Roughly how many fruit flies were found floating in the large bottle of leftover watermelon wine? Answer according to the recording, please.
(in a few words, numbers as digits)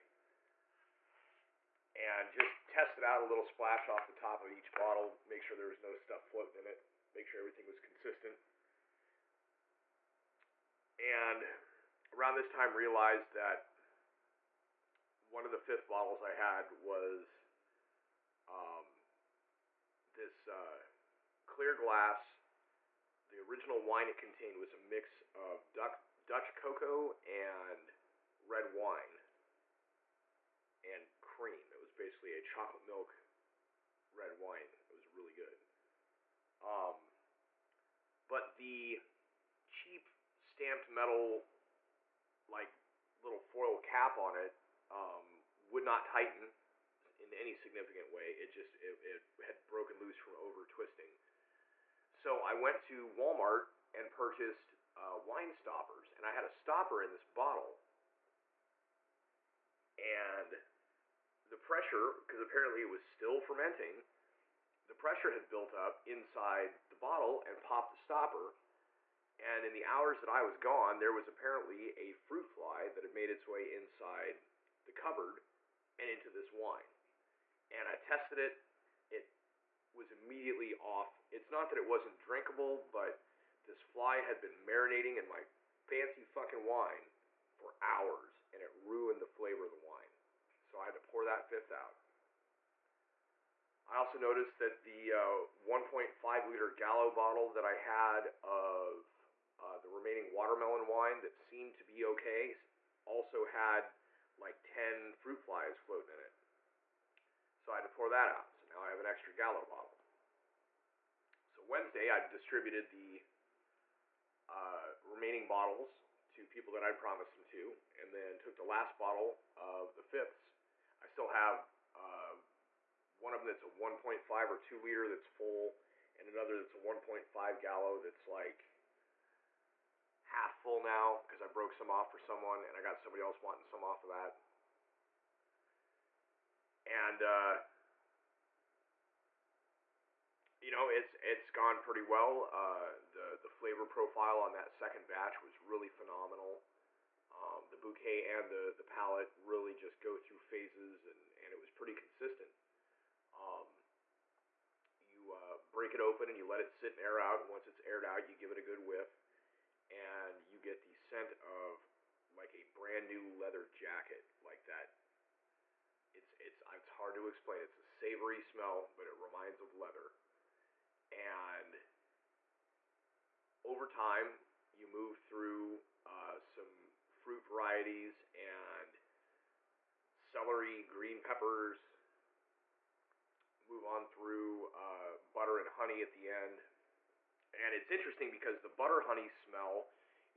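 10.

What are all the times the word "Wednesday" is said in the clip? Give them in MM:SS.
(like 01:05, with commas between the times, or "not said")
01:51.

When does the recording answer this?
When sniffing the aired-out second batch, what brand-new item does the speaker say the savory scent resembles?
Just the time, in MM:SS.
02:43.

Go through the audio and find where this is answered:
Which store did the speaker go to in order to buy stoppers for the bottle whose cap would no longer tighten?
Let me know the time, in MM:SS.
00:53.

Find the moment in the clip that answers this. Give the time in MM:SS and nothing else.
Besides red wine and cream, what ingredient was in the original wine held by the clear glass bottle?
00:26.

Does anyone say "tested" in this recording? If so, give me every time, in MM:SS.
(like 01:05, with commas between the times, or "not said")
00:02, 01:17.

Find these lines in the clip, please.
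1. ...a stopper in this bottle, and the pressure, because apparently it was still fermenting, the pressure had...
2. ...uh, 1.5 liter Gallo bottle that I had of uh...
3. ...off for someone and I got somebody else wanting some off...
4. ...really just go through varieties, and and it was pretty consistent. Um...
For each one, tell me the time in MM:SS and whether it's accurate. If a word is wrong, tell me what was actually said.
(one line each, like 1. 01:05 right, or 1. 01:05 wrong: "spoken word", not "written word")
1. 00:56 right
2. 01:35 right
3. 02:11 right
4. 02:29 wrong: "phases", not "varieties".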